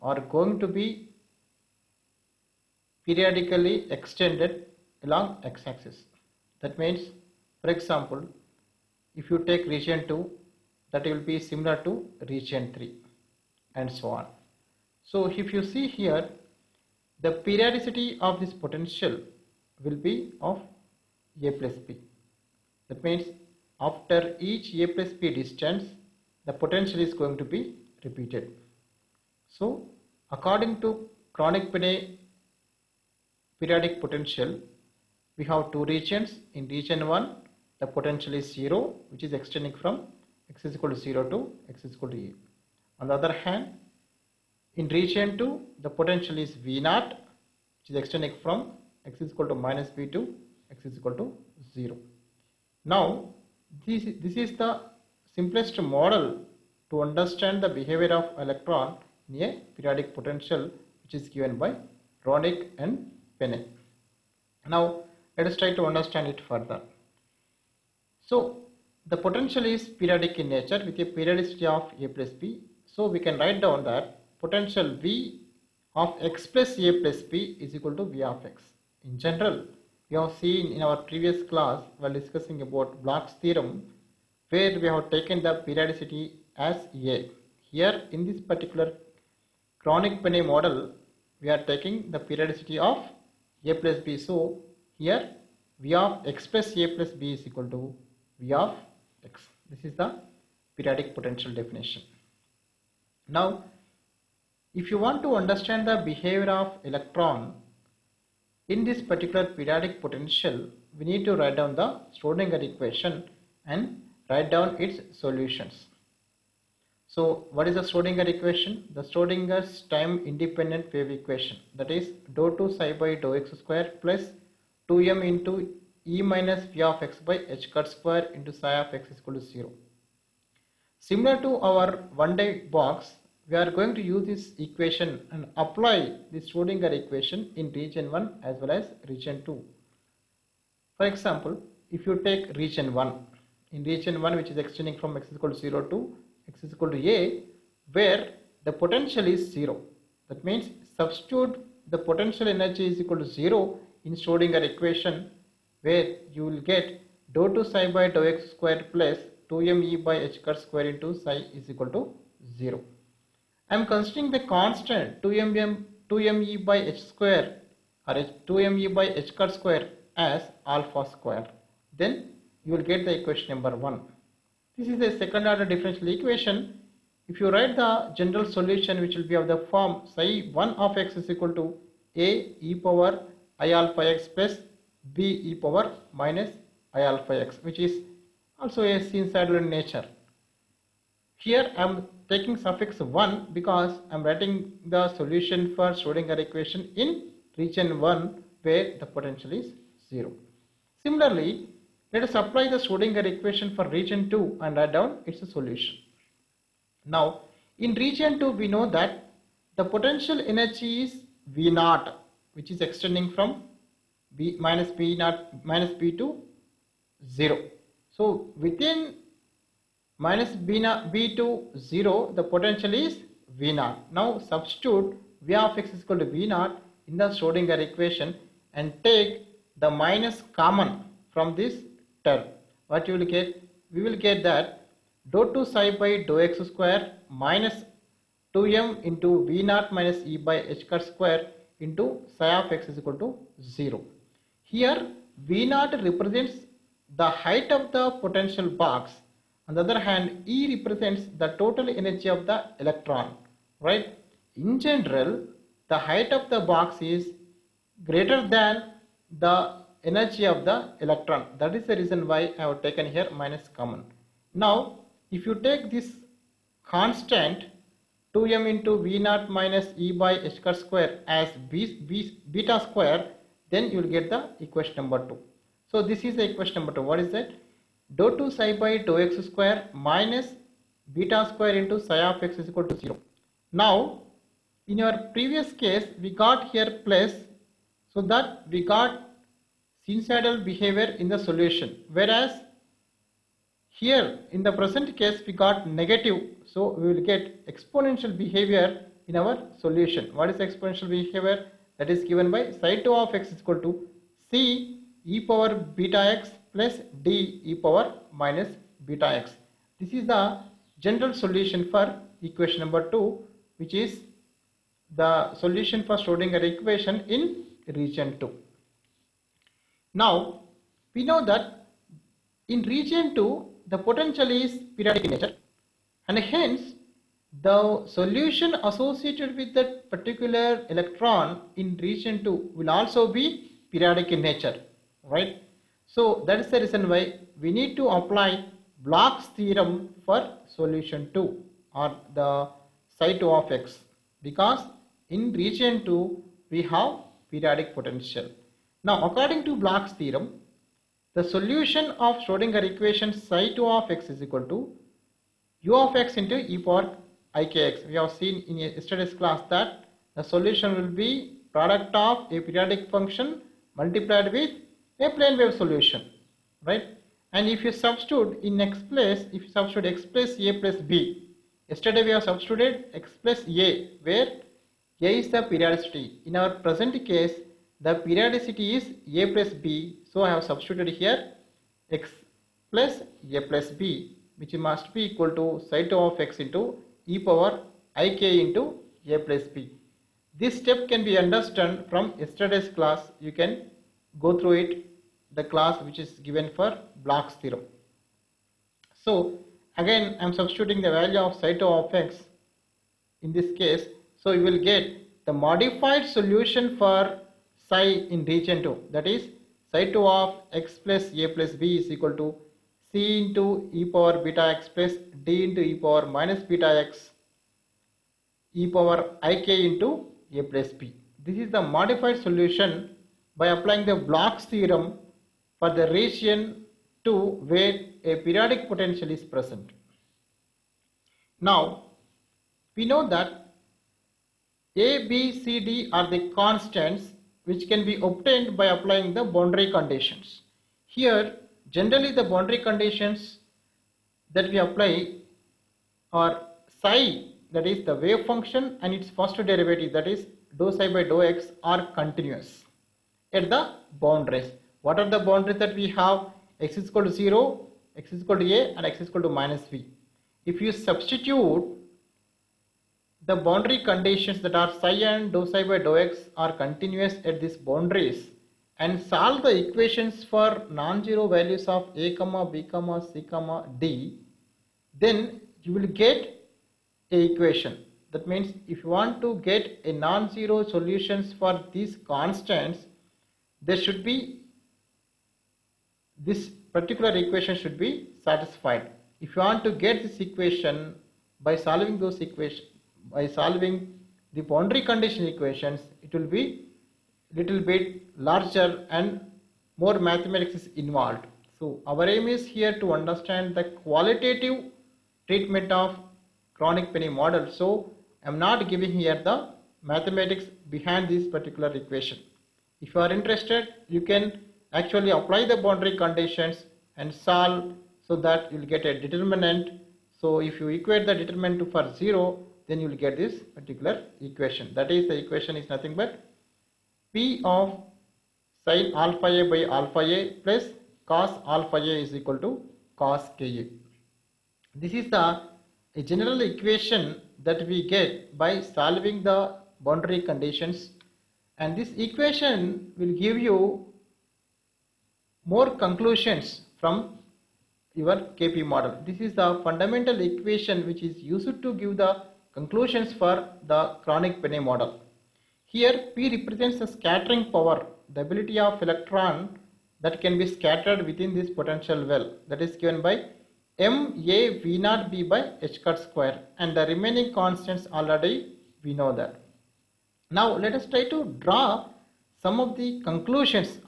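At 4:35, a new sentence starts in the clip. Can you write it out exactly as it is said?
So, this is the equation number 2.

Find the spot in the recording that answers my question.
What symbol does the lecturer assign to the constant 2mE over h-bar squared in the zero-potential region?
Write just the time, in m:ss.
2:50.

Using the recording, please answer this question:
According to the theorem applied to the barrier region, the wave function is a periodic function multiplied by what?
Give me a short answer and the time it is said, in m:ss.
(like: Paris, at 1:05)
plane wave solution, at 6:05.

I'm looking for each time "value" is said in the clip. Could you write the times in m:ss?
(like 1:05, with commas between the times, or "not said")
6:41, 7:51.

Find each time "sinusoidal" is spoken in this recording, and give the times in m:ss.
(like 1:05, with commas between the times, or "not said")
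3:09, 4:50.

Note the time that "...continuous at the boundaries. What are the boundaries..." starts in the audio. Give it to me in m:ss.
7:32.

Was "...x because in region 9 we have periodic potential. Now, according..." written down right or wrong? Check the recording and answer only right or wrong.
wrong.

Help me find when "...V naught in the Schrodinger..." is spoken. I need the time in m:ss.
3:46.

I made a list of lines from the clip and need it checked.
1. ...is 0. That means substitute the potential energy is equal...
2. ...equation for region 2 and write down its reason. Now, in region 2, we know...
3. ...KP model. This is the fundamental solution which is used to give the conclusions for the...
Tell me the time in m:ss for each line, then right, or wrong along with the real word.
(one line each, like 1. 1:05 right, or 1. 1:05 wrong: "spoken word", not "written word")
1. 2:29 right
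2. 3:23 wrong: "solution", not "reason"
3. 9:08 wrong: "equation", not "solution".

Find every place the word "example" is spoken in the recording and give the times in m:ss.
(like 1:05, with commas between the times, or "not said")
0:07, 2:21.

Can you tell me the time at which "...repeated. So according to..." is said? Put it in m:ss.
0:28.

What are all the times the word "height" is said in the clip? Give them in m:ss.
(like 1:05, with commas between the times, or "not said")
4:07, 4:15.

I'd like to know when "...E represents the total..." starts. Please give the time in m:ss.
4:10.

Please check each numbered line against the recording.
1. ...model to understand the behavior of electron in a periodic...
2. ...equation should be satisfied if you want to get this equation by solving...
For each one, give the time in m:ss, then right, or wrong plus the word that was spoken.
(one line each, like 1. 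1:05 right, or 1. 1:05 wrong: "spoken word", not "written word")
1. 0:55 right
2. 8:07 right.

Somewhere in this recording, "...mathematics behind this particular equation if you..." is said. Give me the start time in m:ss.
8:30.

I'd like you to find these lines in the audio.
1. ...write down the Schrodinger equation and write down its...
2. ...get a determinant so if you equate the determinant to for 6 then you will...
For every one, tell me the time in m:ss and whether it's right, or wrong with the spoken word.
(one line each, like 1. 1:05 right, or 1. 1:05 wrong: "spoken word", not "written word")
1. 1:51 right
2. 8:38 wrong: "0", not "6".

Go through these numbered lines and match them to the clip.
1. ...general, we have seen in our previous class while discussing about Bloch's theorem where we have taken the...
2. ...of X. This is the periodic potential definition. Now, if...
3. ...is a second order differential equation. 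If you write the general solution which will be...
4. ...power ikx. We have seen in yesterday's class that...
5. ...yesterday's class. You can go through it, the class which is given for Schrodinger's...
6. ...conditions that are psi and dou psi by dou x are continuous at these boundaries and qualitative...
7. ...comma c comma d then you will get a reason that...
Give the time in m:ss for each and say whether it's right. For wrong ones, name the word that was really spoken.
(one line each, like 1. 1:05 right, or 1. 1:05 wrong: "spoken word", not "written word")
1. 1:19 right
2. 1:38 right
3. 2:54 right
4. 5:56 right
5. 6:32 wrong: "Bloch", not "Schrodinger"
6. 7:44 wrong: "solve", not "qualitative"
7. 7:52 wrong: "equation", not "reason".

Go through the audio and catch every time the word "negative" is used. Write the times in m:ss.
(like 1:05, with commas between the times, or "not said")
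4:55.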